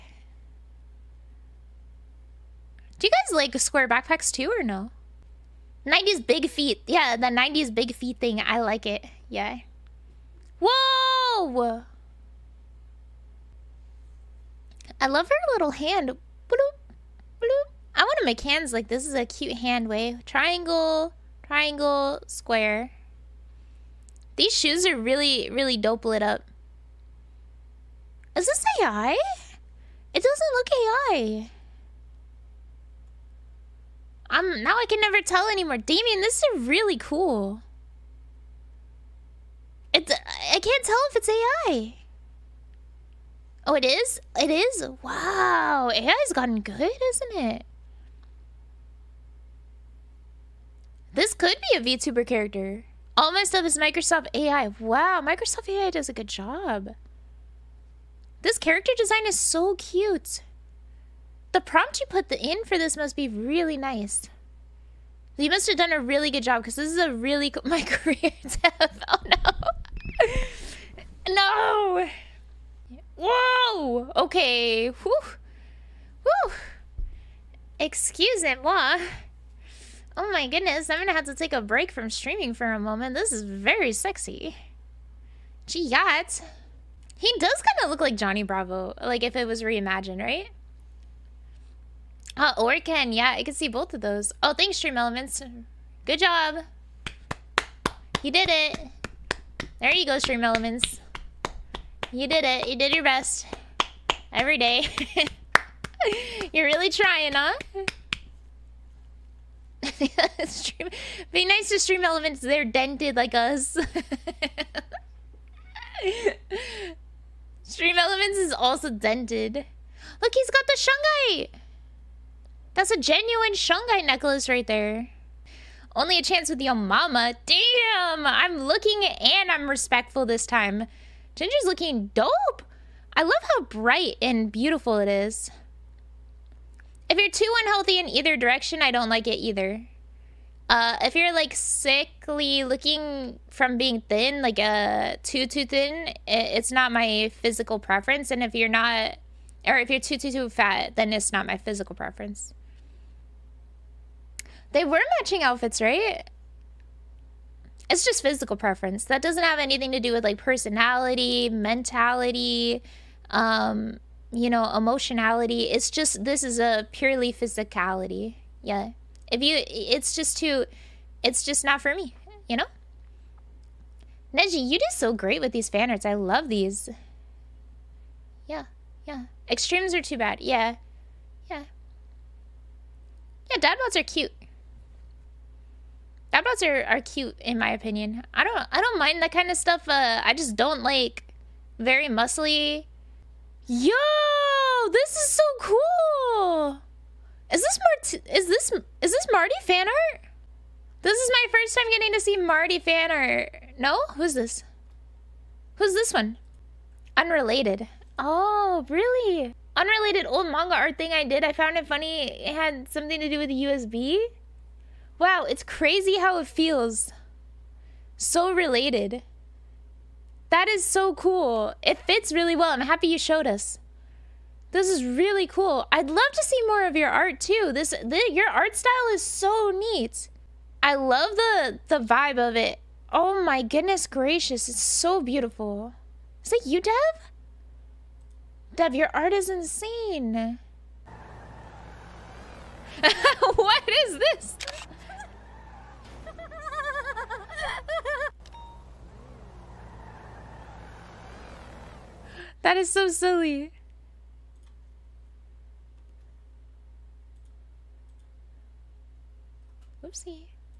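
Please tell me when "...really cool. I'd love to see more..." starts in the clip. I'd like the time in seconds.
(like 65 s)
225 s.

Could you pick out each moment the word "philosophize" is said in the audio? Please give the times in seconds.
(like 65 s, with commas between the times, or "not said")
not said.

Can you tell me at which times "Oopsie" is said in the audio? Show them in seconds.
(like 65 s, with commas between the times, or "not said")
260 s.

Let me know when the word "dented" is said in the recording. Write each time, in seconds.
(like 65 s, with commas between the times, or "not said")
112 s, 118 s.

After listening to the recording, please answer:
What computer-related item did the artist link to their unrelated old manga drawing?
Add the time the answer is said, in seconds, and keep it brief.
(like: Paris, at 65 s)
USB, at 213 s.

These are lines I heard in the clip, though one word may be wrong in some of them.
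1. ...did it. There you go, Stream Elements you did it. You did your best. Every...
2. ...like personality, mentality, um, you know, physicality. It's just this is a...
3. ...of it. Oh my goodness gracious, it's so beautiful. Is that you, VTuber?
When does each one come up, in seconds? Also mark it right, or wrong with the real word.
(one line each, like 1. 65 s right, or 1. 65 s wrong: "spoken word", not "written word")
1. 98 s right
2. 160 s wrong: "emotionality", not "physicality"
3. 232 s wrong: "Dev", not "VTuber".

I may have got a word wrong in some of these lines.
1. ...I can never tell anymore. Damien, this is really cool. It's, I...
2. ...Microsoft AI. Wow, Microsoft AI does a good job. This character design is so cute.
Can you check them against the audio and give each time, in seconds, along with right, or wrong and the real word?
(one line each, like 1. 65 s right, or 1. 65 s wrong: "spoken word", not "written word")
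1. 34 s right
2. 53 s right.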